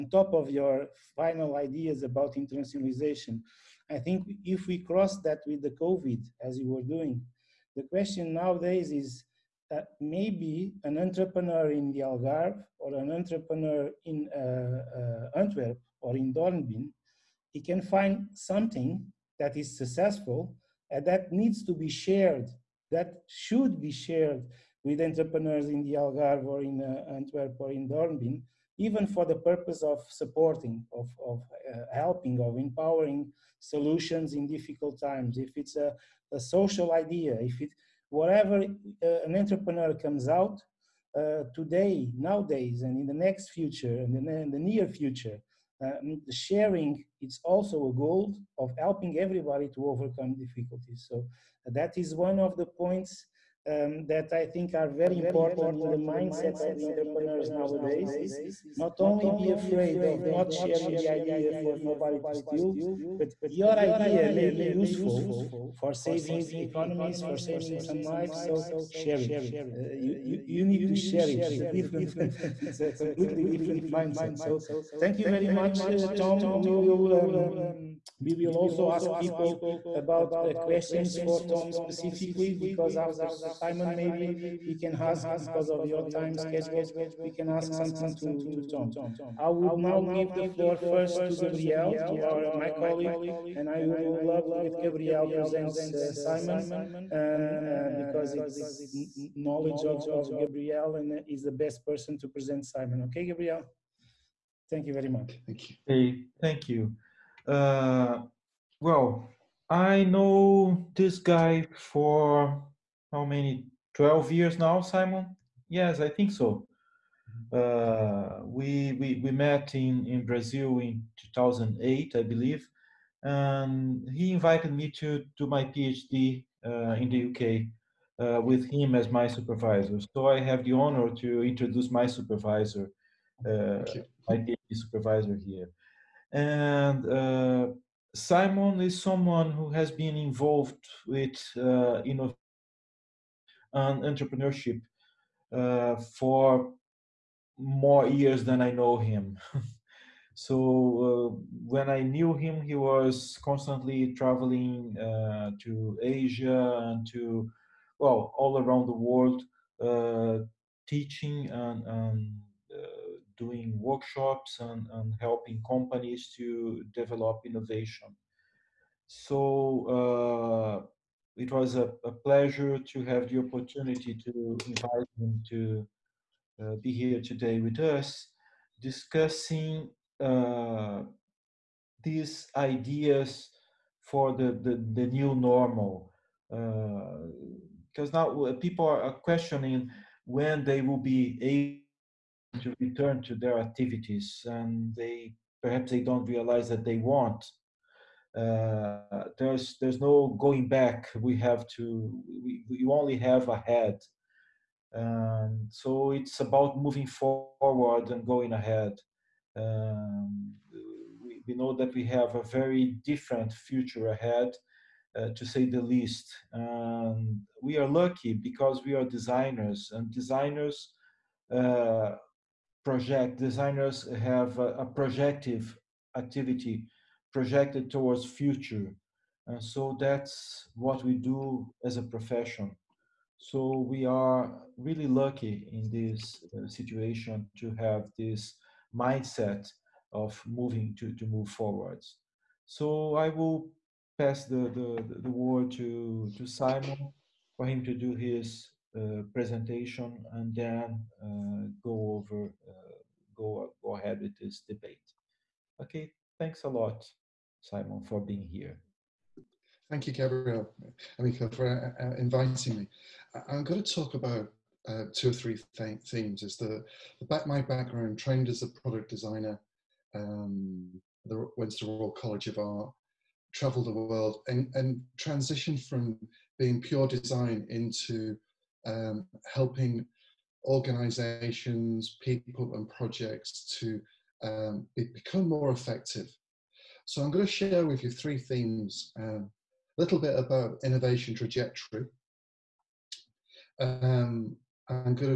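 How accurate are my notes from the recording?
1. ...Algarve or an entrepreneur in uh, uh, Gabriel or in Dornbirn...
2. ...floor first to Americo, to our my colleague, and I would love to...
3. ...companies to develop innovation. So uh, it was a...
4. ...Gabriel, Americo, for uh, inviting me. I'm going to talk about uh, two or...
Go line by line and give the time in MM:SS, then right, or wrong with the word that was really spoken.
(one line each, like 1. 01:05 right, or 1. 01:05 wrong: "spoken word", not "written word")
1. 00:11 wrong: "Antwerp", not "Gabriel"
2. 01:30 wrong: "Gabriel", not "Americo"
3. 02:45 right
4. 04:20 right.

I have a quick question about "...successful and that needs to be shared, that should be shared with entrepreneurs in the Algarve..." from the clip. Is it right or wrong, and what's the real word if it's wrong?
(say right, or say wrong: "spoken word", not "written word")
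right.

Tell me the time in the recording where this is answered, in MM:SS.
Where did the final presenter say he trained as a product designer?
04:31.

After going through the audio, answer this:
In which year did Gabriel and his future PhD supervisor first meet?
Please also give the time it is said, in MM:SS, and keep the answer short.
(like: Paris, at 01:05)
2008, at 02:01.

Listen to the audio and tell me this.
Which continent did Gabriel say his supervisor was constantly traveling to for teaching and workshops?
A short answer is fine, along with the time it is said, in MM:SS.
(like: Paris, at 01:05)
Asia, at 02:36.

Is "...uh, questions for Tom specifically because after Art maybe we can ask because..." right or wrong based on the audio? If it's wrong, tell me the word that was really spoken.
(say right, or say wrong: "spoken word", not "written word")
wrong: "Simon", not "Art".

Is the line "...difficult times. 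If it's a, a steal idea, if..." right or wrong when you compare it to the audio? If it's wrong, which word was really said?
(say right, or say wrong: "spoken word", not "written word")
wrong: "social", not "steal".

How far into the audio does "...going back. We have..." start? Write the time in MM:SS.
03:20.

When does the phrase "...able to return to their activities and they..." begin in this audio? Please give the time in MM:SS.
03:11.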